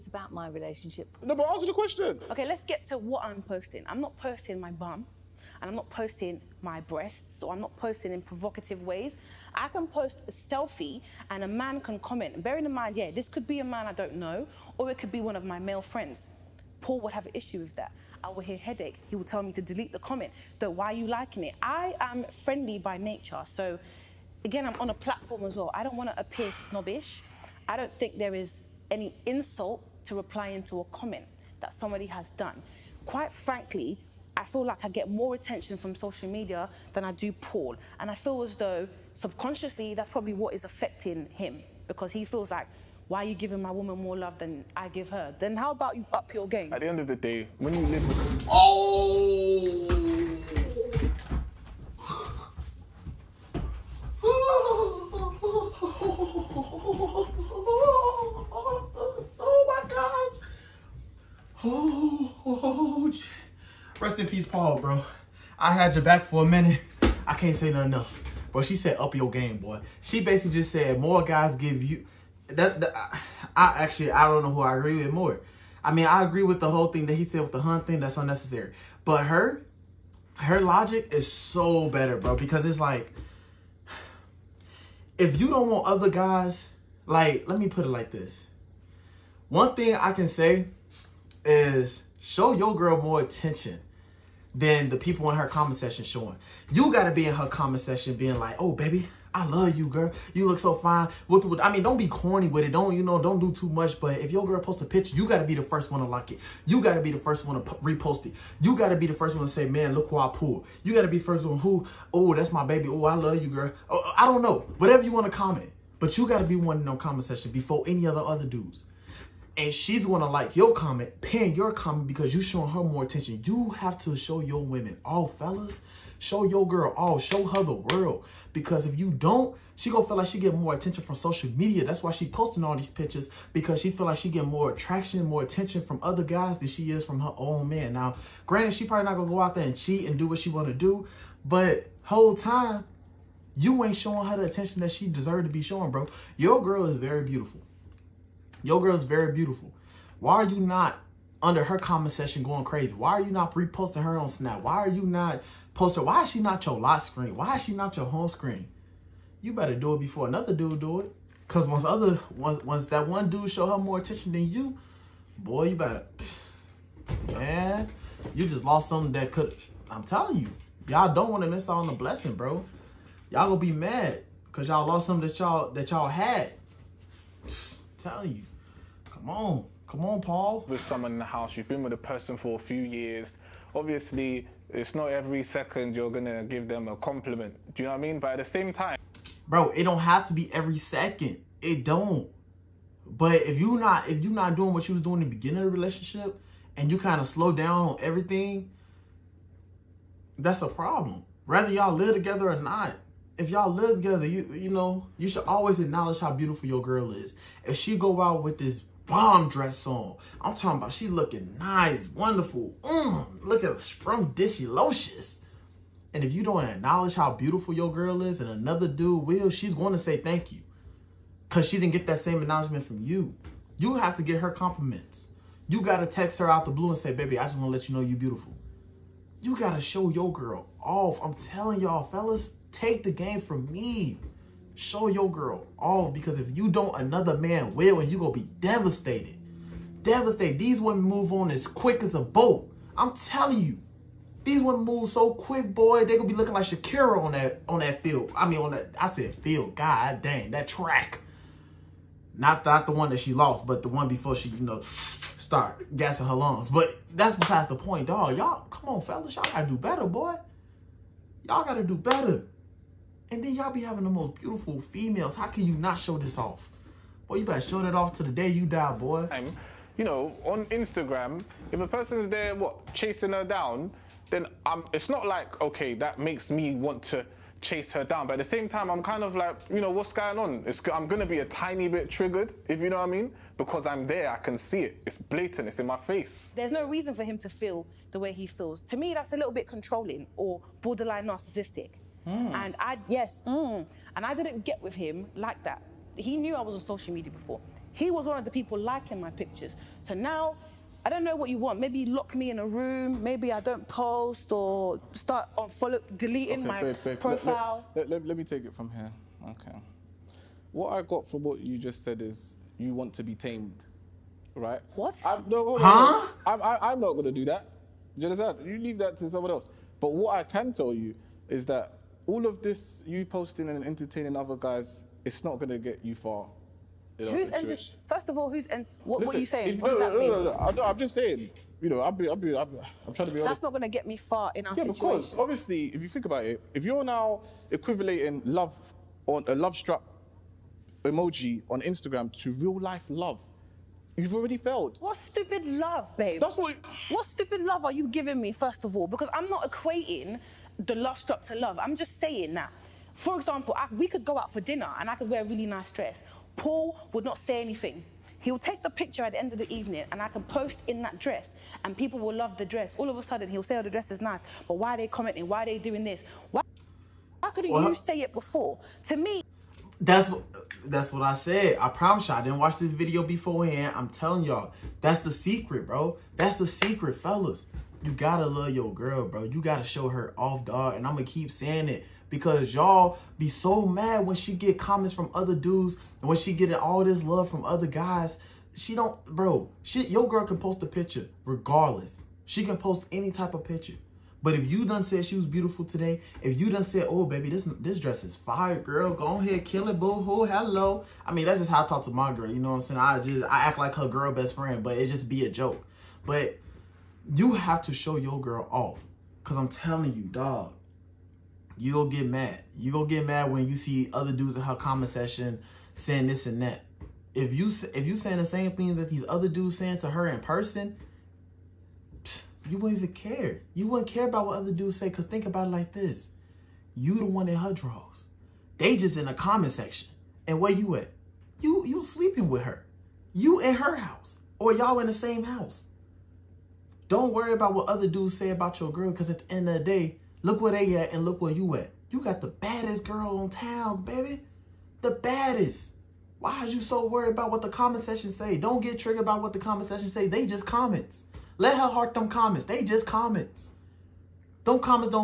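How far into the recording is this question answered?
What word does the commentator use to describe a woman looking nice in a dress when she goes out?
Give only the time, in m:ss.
3:33.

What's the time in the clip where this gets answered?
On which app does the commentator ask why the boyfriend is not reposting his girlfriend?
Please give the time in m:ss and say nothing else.
2:34.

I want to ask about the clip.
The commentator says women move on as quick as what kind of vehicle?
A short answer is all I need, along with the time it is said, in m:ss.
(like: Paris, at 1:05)
A boat, at 4:02.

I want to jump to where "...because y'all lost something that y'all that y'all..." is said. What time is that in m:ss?
2:54.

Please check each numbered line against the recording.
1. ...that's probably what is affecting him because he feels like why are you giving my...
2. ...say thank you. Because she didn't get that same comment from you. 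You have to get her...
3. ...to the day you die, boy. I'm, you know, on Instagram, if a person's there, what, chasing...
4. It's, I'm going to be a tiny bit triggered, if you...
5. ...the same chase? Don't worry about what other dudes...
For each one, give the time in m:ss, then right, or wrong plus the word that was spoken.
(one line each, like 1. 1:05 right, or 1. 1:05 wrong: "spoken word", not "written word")
1. 0:39 right
2. 3:39 wrong: "acknowledgement", not "comment"
3. 4:28 right
4. 4:40 right
5. 7:15 wrong: "house", not "chase".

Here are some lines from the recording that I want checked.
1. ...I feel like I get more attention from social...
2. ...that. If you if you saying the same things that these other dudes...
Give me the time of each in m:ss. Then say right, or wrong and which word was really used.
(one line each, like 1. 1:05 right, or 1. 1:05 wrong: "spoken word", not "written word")
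1. 0:34 right
2. 6:56 right.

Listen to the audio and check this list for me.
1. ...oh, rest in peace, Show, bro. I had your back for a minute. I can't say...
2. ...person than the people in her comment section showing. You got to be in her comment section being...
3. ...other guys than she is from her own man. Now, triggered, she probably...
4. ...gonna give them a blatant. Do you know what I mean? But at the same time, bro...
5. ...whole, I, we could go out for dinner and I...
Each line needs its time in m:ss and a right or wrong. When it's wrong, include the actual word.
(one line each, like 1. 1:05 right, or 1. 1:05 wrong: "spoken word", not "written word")
1. 1:02 wrong: "Paul", not "Show"
2. 1:33 wrong: "attention", not "person"
3. 2:16 wrong: "granted", not "triggered"
4. 3:06 wrong: "compliment", not "blatant"
5. 5:53 wrong: "example", not "whole".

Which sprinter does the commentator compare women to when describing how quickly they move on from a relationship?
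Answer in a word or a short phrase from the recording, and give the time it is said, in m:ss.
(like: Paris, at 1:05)
Sha'Carri, at 4:06.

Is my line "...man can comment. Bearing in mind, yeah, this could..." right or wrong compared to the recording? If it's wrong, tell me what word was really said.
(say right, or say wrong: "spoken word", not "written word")
right.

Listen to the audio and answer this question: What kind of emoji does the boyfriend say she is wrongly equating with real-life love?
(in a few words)
Love struck.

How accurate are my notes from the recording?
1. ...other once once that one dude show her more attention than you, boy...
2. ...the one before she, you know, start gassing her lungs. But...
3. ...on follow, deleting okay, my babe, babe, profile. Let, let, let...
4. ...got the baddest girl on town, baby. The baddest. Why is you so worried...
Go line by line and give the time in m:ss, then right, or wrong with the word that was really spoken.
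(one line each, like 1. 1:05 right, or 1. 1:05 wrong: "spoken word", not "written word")
1. 2:41 right
2. 4:13 right
3. 5:05 right
4. 7:22 right.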